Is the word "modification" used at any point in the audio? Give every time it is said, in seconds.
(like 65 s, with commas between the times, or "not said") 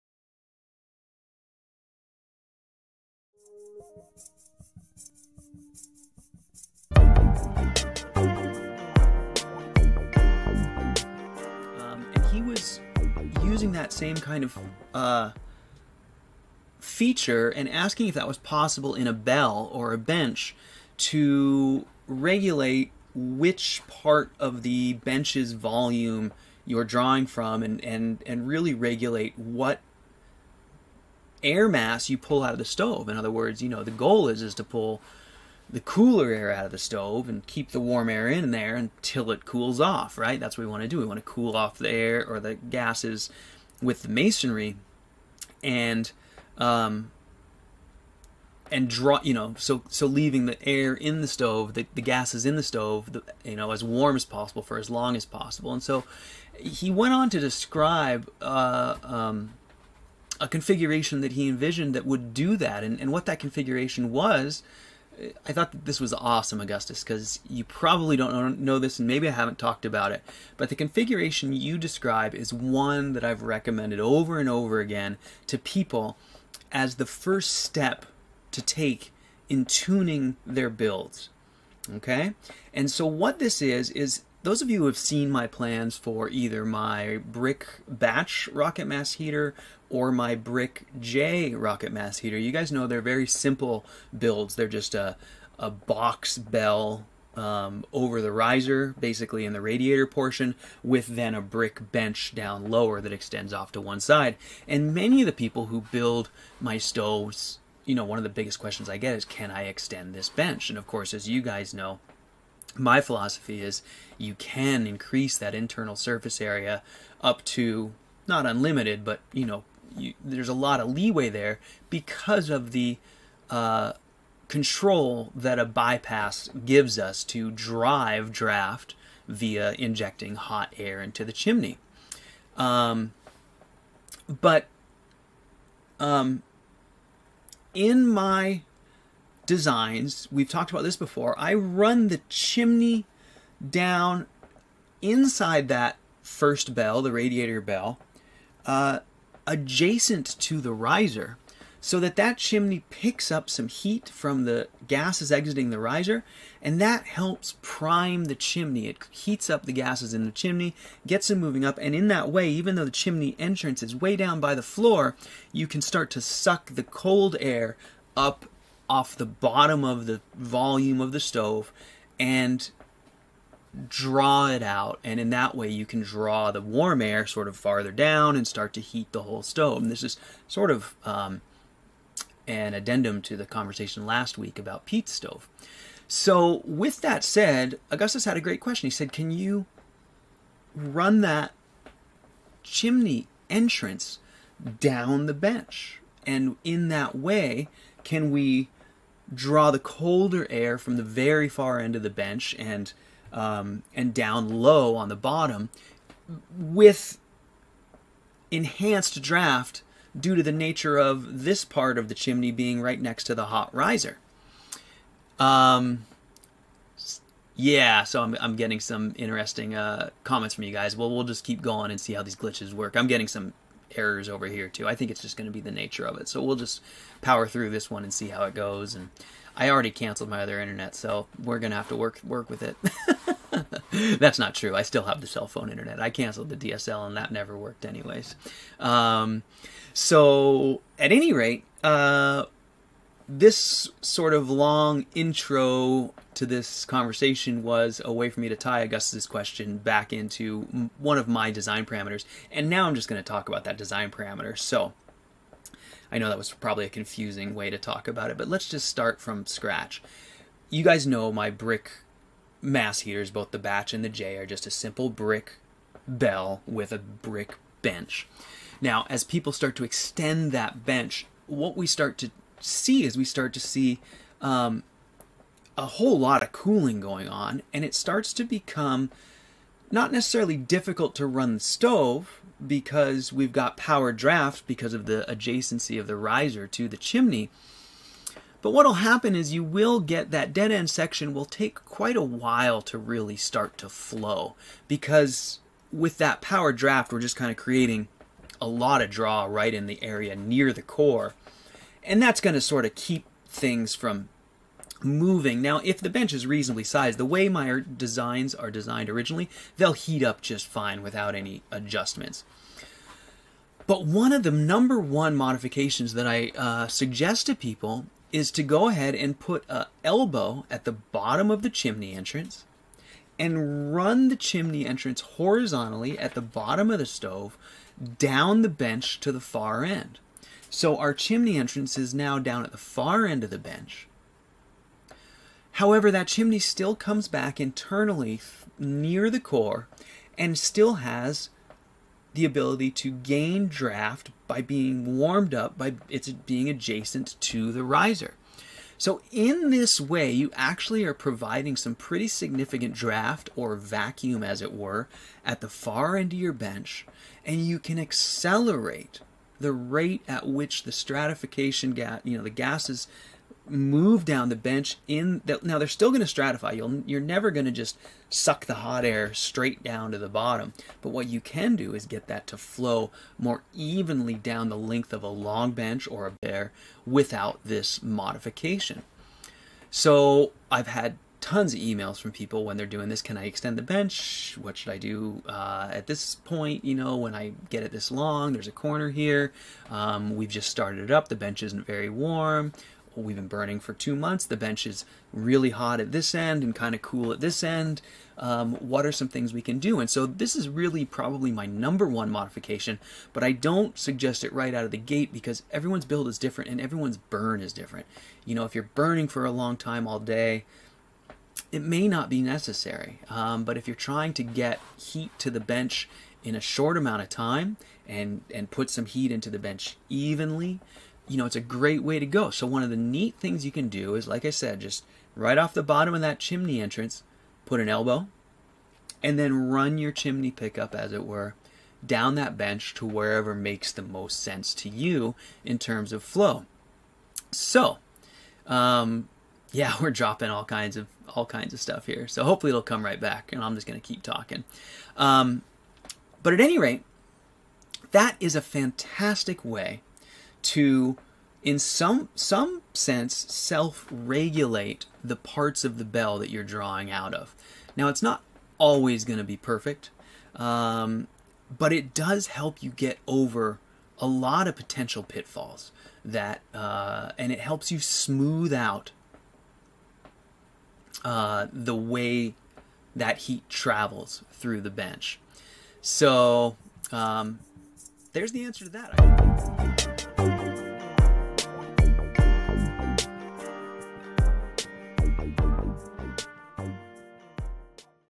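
315 s, 378 s, 402 s.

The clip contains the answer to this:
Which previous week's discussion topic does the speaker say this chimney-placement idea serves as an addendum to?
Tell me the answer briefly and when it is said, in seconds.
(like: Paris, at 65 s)
peat stove, at 184 s.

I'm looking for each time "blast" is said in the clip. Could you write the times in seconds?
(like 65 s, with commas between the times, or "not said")
not said.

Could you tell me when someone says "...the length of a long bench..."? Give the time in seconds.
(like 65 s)
374 s.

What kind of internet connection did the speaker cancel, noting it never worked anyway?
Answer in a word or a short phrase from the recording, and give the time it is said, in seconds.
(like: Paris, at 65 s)
DSL, at 236 s.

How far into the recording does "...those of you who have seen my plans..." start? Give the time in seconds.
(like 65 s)
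84 s.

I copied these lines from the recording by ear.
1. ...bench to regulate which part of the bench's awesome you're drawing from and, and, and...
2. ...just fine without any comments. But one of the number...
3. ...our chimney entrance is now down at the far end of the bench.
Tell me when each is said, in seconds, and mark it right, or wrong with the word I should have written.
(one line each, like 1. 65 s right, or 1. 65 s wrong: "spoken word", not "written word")
1. 19 s wrong: "volume", not "awesome"
2. 310 s wrong: "adjustments", not "comments"
3. 330 s right.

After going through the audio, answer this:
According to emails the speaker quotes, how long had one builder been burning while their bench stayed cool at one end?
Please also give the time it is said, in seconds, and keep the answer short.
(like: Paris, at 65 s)
2 months, at 393 s.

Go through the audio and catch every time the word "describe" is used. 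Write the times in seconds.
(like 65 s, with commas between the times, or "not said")
57 s, 71 s.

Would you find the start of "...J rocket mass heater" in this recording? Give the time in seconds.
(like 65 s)
90 s.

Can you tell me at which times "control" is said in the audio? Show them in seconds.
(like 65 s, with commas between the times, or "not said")
124 s.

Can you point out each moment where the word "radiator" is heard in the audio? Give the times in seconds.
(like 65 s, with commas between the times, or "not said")
99 s, 147 s.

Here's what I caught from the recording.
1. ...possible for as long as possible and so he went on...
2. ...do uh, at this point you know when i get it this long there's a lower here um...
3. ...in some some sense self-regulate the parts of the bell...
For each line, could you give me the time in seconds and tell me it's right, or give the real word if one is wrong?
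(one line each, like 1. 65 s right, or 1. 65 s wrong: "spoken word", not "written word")
1. 54 s right
2. 384 s wrong: "corner", not "lower"
3. 451 s right.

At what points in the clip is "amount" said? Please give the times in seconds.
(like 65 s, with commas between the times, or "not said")
416 s.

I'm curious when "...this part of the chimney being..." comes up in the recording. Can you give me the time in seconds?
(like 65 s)
211 s.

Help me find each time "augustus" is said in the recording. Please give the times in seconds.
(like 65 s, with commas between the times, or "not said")
66 s, 187 s, 248 s.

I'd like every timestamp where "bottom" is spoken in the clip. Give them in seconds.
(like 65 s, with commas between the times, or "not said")
169 s, 205 s, 320 s, 326 s, 370 s, 425 s.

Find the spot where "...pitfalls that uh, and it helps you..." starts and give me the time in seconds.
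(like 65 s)
465 s.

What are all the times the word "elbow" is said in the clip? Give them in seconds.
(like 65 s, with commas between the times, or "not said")
320 s, 427 s.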